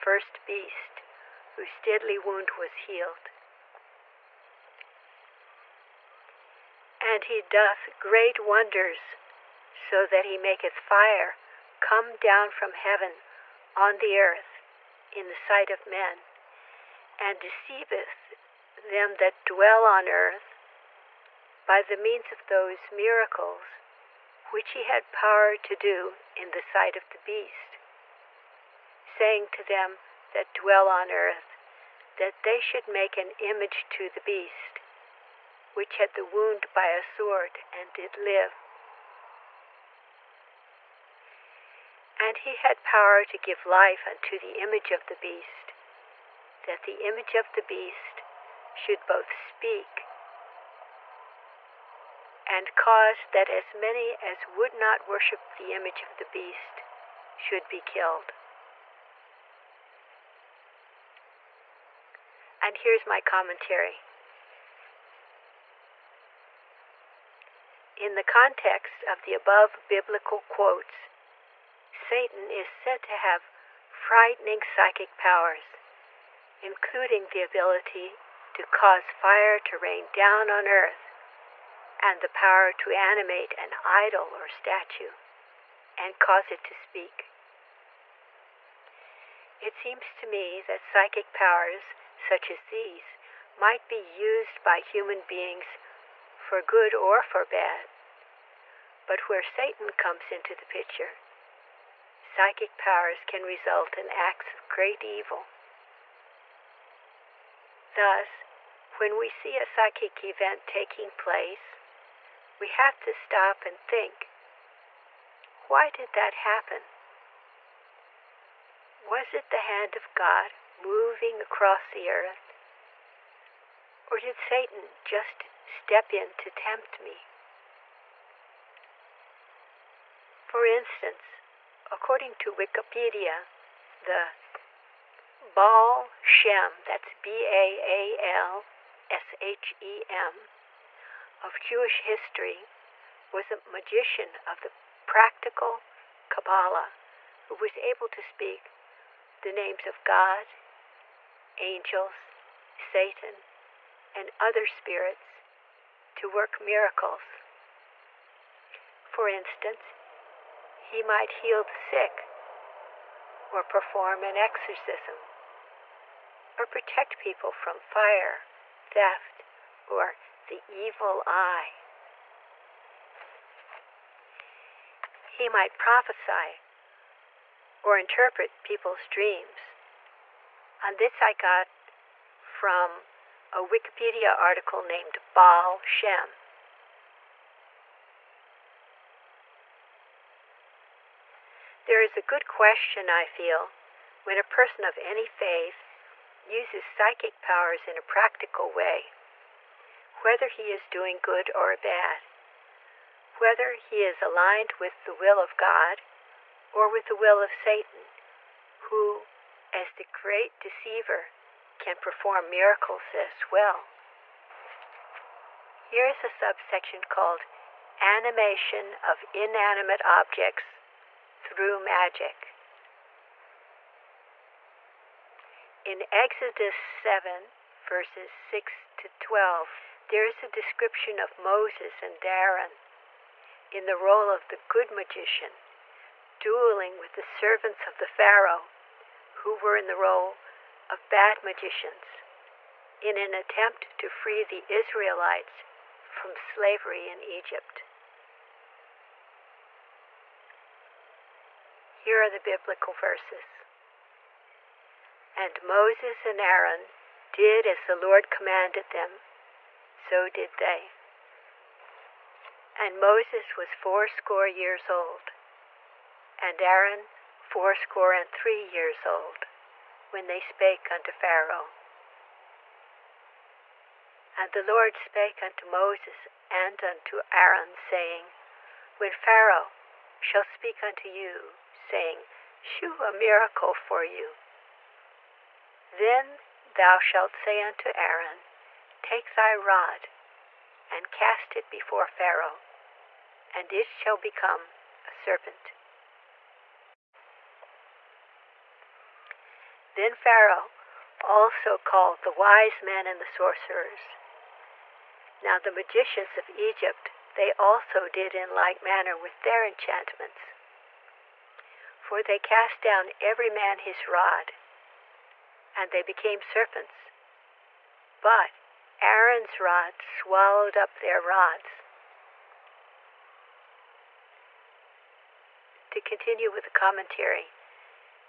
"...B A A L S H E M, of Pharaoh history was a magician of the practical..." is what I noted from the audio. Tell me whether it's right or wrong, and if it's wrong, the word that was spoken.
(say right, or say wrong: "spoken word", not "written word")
wrong: "Jewish", not "Pharaoh".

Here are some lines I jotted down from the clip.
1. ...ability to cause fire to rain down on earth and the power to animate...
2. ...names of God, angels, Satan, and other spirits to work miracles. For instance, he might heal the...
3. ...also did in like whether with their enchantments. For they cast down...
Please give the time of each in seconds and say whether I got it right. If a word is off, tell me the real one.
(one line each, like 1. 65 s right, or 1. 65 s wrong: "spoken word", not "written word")
1. 77 s right
2. 149 s right
3. 307 s wrong: "manner", not "whether".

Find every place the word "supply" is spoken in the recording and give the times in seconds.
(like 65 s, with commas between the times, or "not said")
not said.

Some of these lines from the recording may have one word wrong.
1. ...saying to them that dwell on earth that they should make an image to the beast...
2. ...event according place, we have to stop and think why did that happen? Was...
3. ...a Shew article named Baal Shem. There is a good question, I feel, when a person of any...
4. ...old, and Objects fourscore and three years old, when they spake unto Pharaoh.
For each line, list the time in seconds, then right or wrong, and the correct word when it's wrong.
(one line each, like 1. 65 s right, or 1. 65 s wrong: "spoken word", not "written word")
1. 29 s right
2. 110 s wrong: "taking", not "according"
3. 183 s wrong: "Wikipedia", not "Shew"
4. 264 s wrong: "Aaron", not "Objects".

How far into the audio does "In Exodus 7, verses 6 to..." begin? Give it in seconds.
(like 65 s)
225 s.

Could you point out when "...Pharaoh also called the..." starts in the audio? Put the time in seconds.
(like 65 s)
300 s.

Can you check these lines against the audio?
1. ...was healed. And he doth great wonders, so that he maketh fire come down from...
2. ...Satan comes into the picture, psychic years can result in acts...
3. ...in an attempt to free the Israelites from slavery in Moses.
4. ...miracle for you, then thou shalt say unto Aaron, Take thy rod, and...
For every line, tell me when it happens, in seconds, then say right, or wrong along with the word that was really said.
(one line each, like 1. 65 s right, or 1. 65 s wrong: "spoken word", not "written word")
1. 2 s right
2. 99 s wrong: "powers", not "years"
3. 242 s wrong: "Egypt", not "Moses"
4. 283 s right.